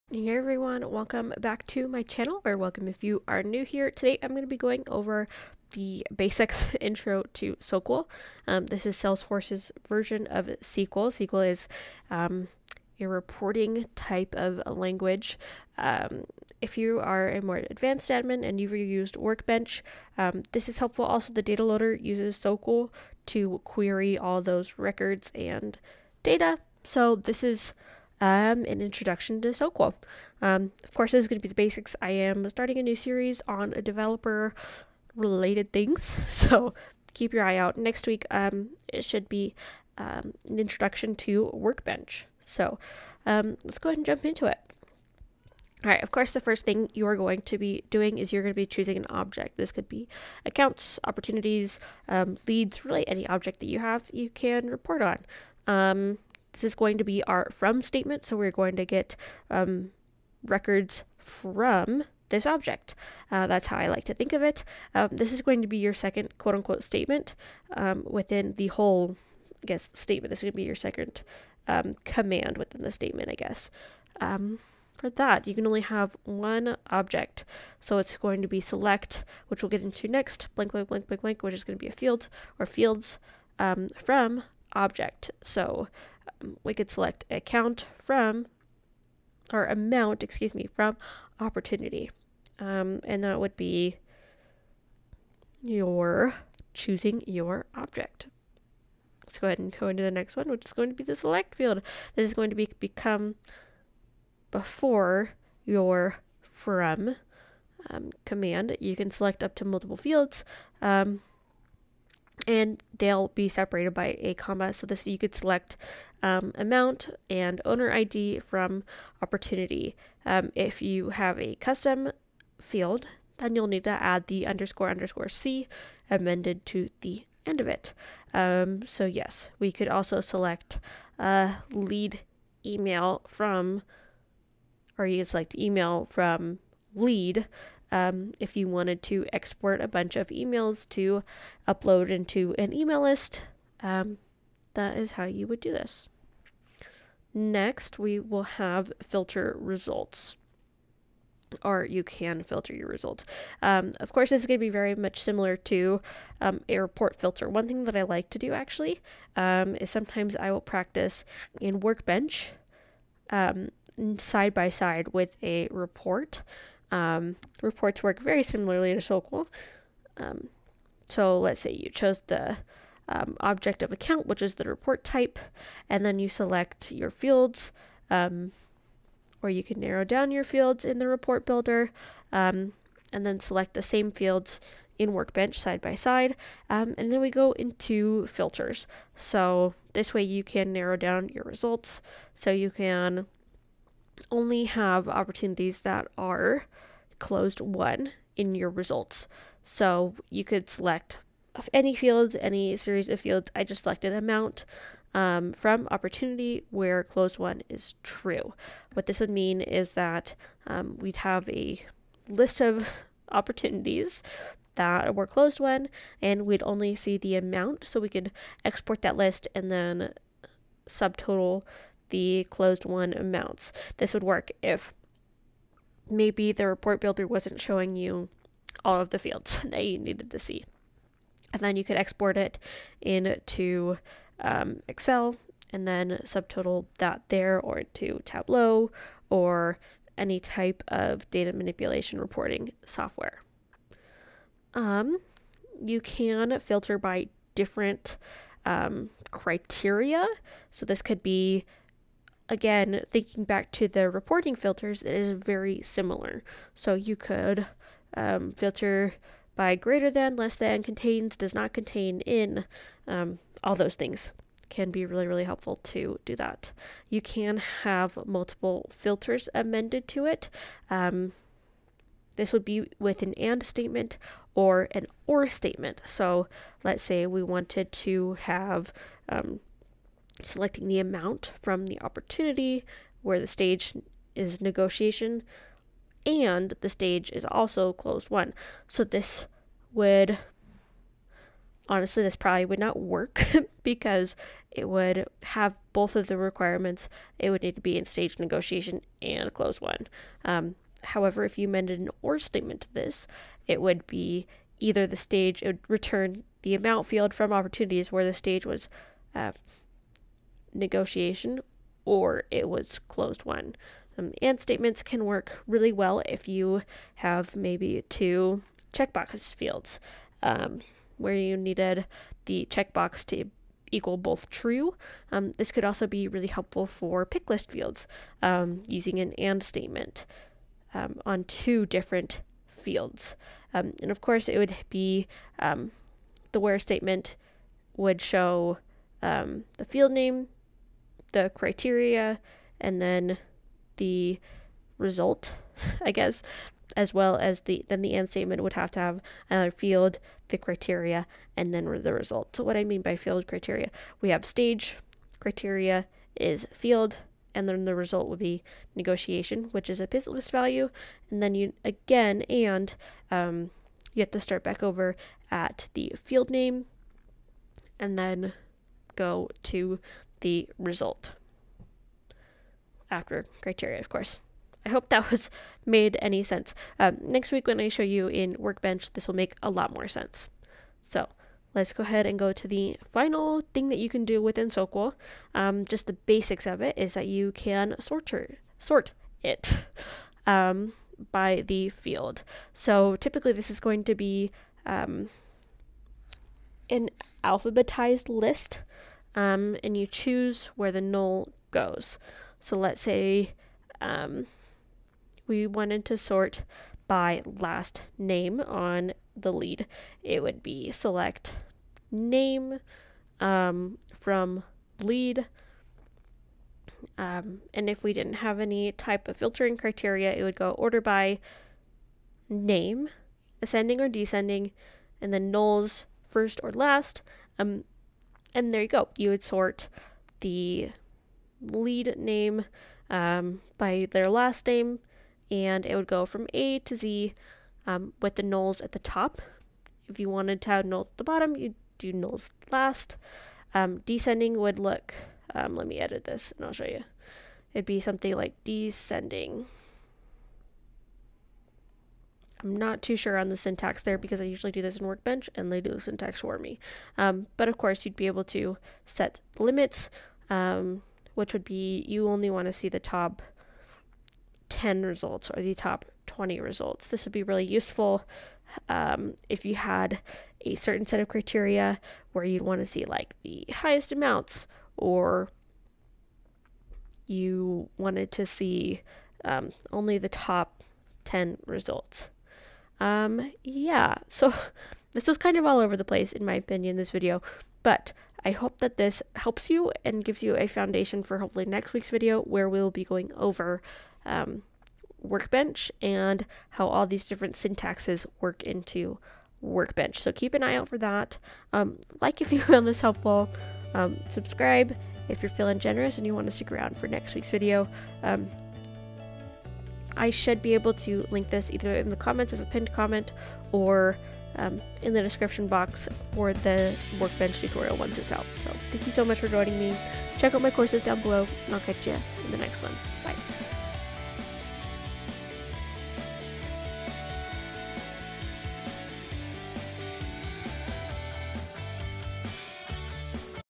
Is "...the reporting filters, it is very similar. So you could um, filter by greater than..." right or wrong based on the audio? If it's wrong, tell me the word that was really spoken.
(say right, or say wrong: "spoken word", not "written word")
right.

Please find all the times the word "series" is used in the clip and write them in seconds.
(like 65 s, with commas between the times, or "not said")
32 s, 202 s.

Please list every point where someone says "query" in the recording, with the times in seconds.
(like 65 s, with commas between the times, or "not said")
23 s.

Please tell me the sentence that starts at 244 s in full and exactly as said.
Um, you can filter by different um, criteria.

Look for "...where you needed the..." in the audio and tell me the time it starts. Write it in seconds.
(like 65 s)
321 s.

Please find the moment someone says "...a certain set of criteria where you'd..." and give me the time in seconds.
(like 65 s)
470 s.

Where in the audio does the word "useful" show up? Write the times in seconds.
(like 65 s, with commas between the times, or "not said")
467 s.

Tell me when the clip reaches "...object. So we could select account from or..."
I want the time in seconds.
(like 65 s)
84 s.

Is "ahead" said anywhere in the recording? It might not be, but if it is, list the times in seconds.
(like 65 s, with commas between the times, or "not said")
43 s, 99 s, 382 s.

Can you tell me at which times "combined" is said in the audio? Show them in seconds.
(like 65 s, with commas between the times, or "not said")
not said.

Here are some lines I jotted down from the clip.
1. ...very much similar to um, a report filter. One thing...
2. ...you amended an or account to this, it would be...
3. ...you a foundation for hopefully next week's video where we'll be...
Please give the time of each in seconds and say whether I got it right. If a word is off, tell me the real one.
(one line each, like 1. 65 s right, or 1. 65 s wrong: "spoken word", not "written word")
1. 154 s right
2. 301 s wrong: "statement", not "account"
3. 490 s right.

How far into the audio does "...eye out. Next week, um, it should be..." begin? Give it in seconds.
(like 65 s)
37 s.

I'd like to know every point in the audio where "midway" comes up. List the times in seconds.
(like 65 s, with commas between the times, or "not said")
not said.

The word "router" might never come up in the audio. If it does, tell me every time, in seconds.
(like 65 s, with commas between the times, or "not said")
not said.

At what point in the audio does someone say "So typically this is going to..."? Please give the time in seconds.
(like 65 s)
392 s.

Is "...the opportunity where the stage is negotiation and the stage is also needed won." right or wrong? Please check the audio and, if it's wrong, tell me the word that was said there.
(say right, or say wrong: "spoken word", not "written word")
wrong: "closed", not "needed".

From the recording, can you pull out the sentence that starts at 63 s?
Uh, that's how I like to think of it.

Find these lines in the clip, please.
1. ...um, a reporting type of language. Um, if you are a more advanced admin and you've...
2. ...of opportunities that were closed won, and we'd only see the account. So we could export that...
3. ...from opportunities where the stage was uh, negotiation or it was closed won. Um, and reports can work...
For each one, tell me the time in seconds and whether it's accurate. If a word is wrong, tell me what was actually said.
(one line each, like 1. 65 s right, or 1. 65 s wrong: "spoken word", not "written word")
1. 12 s right
2. 212 s wrong: "amount", not "account"
3. 307 s wrong: "statements", not "reports".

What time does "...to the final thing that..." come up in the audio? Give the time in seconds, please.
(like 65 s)
382 s.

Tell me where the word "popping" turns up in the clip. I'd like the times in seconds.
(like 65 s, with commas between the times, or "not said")
not said.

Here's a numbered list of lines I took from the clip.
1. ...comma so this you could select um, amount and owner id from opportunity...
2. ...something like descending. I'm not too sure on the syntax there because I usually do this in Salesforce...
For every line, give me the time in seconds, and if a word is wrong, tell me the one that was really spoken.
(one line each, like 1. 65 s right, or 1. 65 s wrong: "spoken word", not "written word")
1. 114 s right
2. 448 s wrong: "Workbench", not "Salesforce".